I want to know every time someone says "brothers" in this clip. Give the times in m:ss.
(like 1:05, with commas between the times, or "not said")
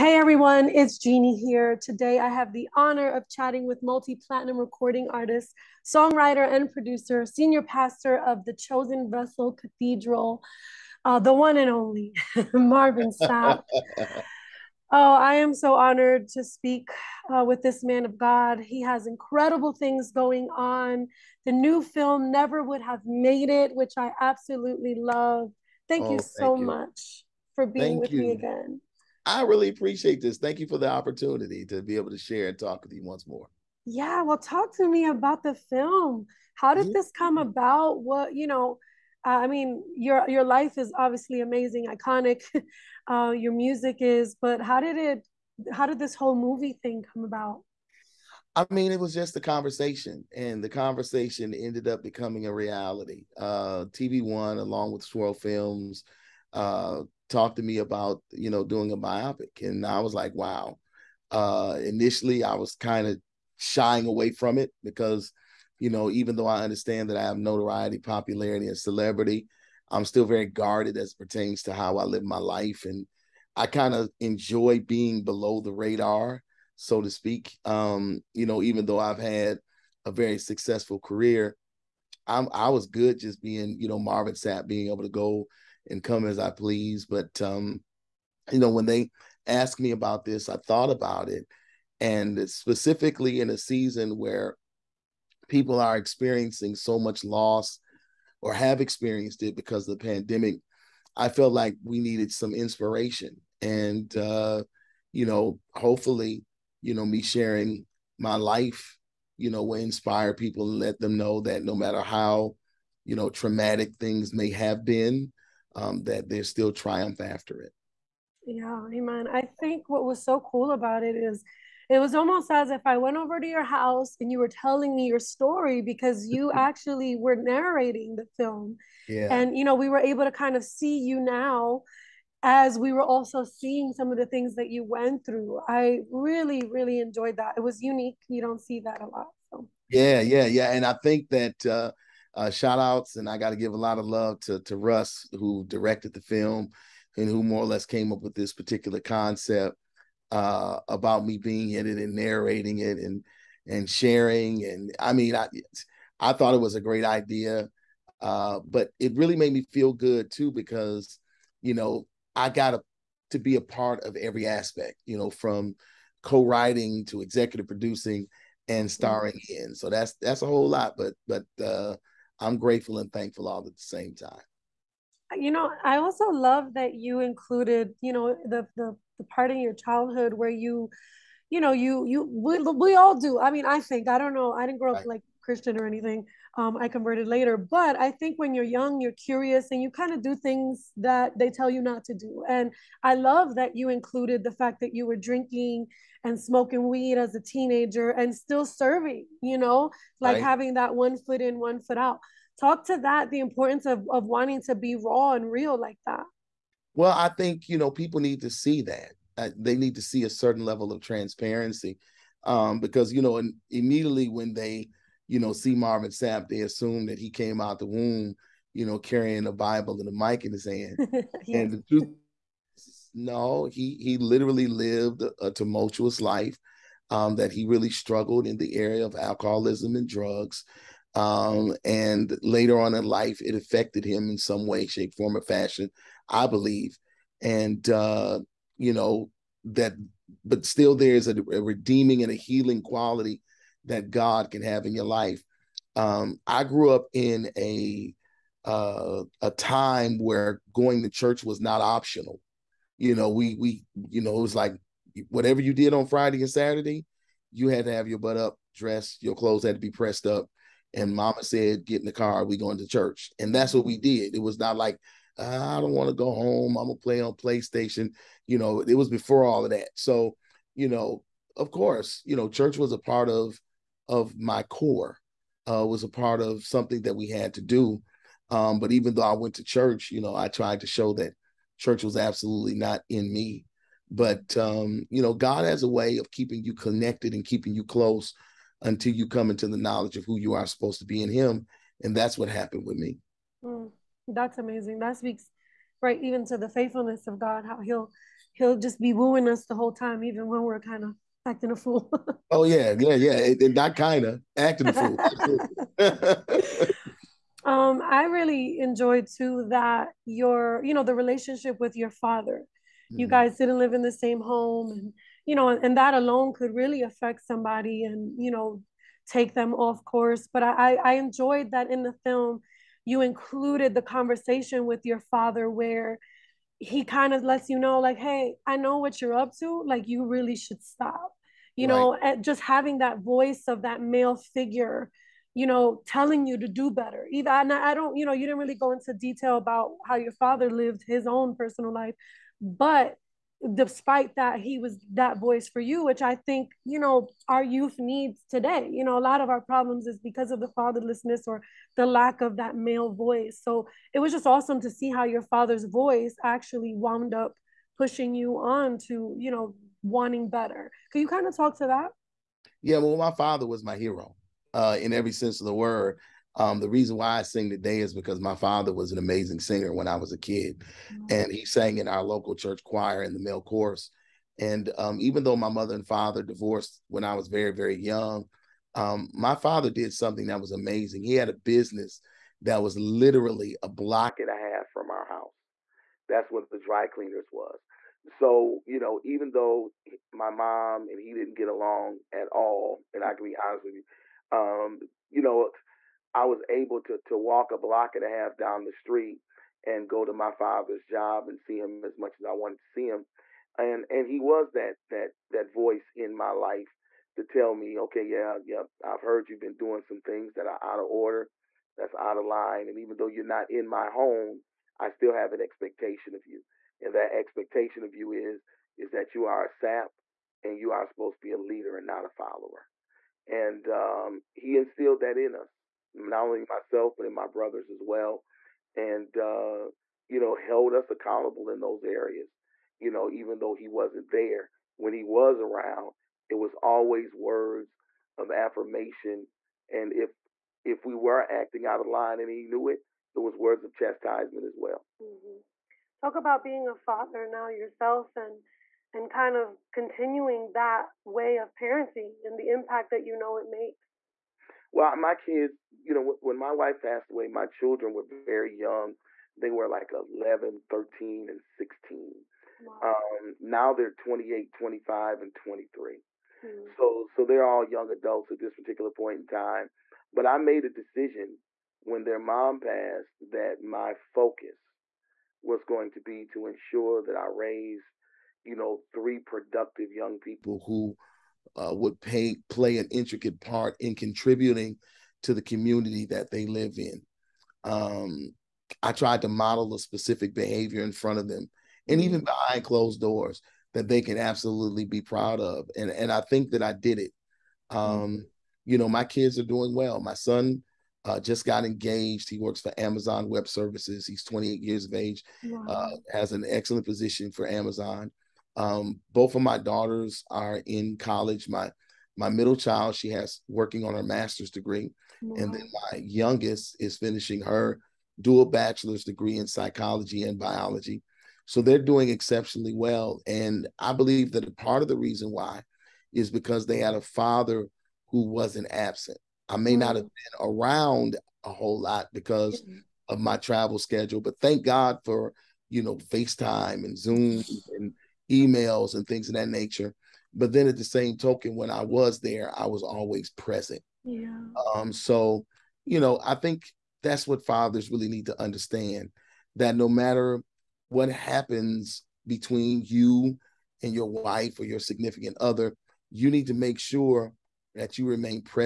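7:07.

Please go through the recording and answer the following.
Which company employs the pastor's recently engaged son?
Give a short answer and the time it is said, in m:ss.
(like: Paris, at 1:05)
Amazon Web Services, at 8:22.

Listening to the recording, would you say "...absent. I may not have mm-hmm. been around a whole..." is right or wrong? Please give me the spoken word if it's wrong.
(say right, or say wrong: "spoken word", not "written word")
right.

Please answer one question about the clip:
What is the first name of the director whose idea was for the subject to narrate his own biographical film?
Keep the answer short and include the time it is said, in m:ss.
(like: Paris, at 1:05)
Russ, at 2:24.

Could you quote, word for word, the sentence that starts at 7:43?
um, now they're 28 25 and 23 mm-hmm.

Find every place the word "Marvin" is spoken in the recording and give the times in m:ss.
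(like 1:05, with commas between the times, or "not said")
0:12, 1:23, 3:35.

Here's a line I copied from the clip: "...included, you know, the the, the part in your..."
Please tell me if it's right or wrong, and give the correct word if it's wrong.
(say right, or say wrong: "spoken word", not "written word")
right.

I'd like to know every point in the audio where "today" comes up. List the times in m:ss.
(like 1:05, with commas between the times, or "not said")
0:01, 5:48, 6:07.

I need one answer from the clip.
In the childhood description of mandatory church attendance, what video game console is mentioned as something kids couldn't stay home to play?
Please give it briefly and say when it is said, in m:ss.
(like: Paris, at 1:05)
PlayStation, at 4:27.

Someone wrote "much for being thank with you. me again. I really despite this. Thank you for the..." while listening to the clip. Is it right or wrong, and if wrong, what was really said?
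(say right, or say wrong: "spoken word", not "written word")
wrong: "appreciate", not "despite".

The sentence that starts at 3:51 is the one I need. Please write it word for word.
Um, and later on in life, it affected him in some way, shape, form, or fashion, I believe.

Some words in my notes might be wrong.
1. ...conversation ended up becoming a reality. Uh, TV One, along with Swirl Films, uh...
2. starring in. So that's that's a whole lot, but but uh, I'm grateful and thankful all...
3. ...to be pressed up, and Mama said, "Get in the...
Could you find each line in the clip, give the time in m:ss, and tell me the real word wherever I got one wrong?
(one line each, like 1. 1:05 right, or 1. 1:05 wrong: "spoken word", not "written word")
1. 0:50 right
2. 2:48 right
3. 4:19 right.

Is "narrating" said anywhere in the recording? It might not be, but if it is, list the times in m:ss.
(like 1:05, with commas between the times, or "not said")
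2:07, 2:32.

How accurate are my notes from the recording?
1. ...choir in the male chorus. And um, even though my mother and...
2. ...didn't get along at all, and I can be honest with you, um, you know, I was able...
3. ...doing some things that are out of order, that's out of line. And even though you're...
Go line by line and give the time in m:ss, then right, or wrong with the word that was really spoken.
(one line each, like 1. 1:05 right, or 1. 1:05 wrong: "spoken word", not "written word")
1. 6:12 right
2. 6:31 right
3. 6:49 right.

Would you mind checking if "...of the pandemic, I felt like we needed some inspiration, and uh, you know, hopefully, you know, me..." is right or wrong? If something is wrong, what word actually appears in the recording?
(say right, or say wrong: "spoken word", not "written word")
right.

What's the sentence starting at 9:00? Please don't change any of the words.
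But then at the same token, when I was there, I was always present.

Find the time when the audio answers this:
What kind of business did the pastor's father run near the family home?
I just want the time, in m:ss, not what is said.
6:26.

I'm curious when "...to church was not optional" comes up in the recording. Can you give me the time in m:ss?
4:11.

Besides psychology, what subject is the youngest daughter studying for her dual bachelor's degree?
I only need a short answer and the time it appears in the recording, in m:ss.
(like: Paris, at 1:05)
Biology, at 8:40.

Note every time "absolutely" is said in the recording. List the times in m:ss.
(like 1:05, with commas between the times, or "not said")
0:24, 4:42, 8:14.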